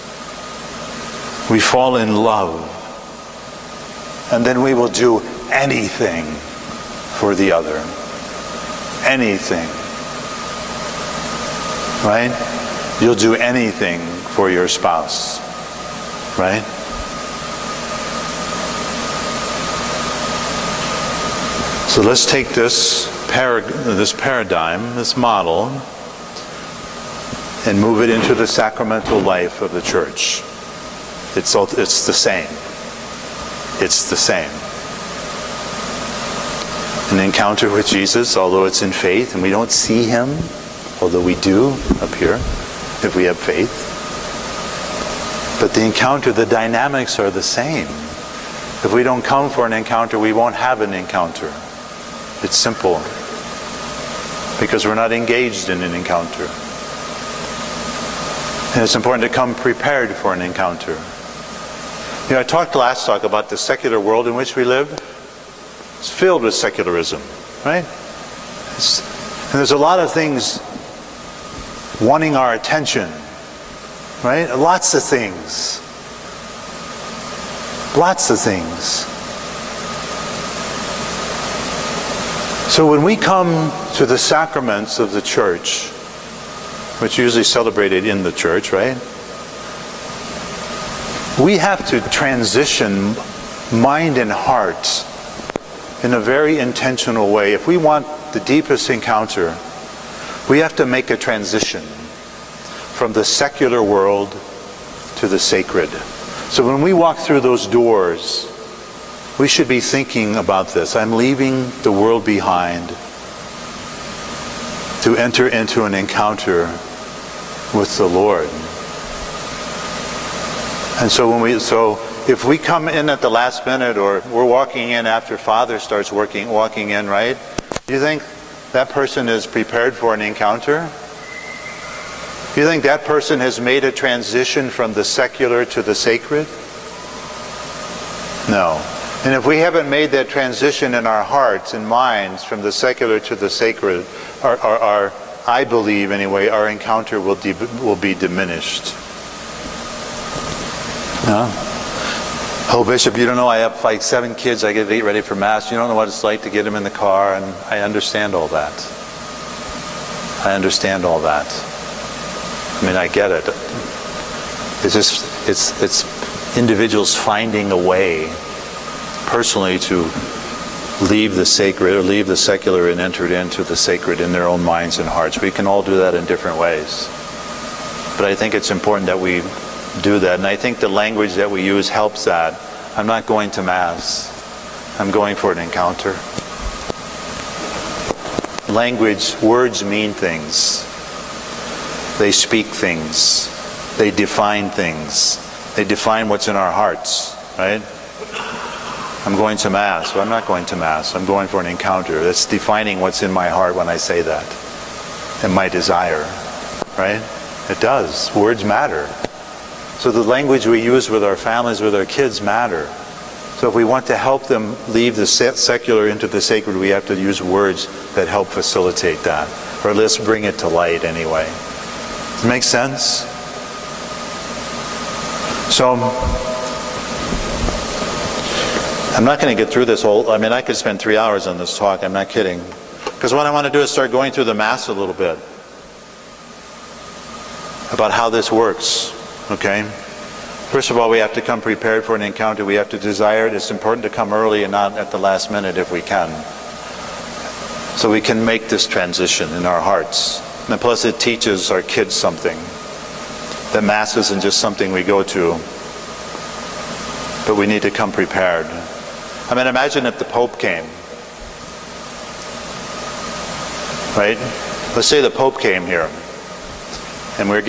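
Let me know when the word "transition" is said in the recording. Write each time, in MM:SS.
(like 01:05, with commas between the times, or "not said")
01:32, 01:41, 02:13, 02:20, 04:08.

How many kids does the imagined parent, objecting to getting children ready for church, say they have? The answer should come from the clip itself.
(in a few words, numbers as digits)
7.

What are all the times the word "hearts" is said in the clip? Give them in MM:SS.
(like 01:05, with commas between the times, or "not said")
01:34, 02:21, 02:55, 03:16, 03:23, 04:09.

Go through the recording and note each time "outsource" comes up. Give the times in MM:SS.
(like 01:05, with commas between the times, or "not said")
not said.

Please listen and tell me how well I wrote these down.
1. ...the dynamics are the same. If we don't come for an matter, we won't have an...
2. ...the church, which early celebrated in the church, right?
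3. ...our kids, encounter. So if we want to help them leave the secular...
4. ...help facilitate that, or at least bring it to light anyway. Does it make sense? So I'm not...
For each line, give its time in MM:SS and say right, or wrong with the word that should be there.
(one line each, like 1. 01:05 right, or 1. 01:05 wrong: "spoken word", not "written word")
1. 00:46 wrong: "encounter", not "matter"
2. 01:25 wrong: "usually", not "early"
3. 03:31 wrong: "matter", not "encounter"
4. 03:38 right.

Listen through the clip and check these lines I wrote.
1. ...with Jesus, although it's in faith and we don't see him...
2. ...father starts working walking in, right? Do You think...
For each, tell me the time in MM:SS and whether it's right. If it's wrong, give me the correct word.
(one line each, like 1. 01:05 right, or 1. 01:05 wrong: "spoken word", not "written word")
1. 00:37 right
2. 02:05 right.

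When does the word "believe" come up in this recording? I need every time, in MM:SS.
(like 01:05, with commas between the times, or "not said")
02:25.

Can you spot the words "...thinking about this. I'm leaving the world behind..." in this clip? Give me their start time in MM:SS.
01:49.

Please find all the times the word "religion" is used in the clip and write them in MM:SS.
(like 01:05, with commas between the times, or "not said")
not said.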